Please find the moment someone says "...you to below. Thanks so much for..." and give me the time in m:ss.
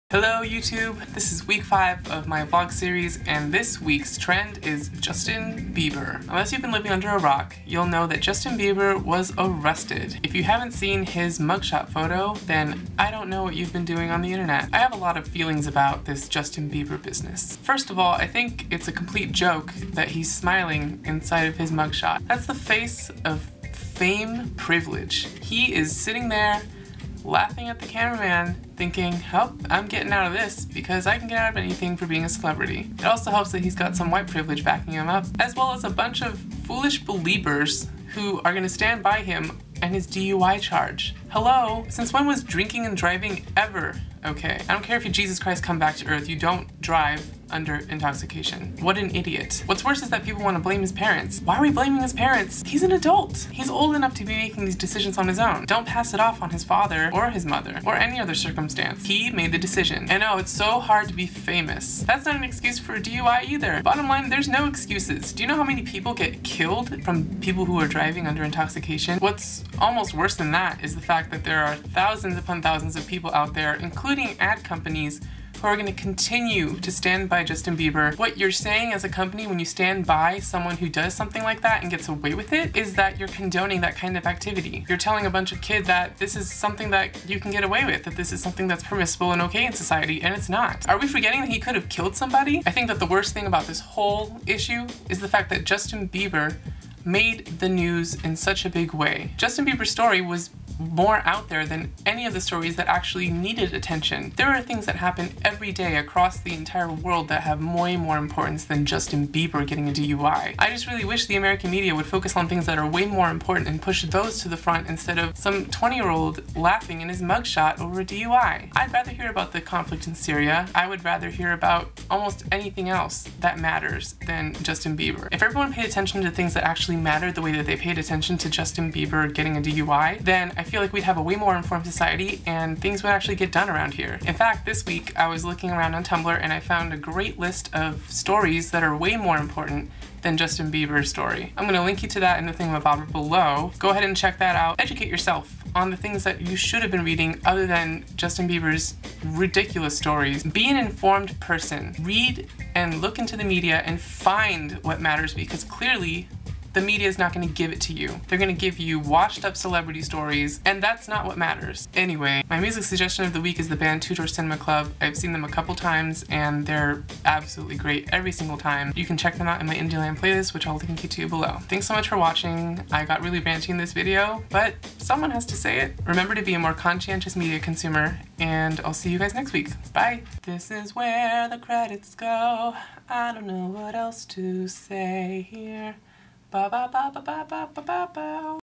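2:51.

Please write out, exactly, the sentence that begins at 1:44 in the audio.
There are things that happen every day across the entire world that have way more importance than Justin Bieber getting a DUI.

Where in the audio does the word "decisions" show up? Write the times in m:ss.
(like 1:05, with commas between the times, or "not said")
0:54, 0:59.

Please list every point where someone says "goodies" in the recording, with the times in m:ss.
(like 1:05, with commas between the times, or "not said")
not said.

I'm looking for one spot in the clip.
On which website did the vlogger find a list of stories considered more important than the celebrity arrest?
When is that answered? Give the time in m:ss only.
2:16.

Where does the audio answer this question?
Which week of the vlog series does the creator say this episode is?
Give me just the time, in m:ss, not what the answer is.
0:01.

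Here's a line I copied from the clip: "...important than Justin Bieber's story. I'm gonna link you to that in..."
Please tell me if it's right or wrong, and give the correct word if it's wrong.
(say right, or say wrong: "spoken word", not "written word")
right.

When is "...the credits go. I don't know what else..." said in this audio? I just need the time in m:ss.
3:01.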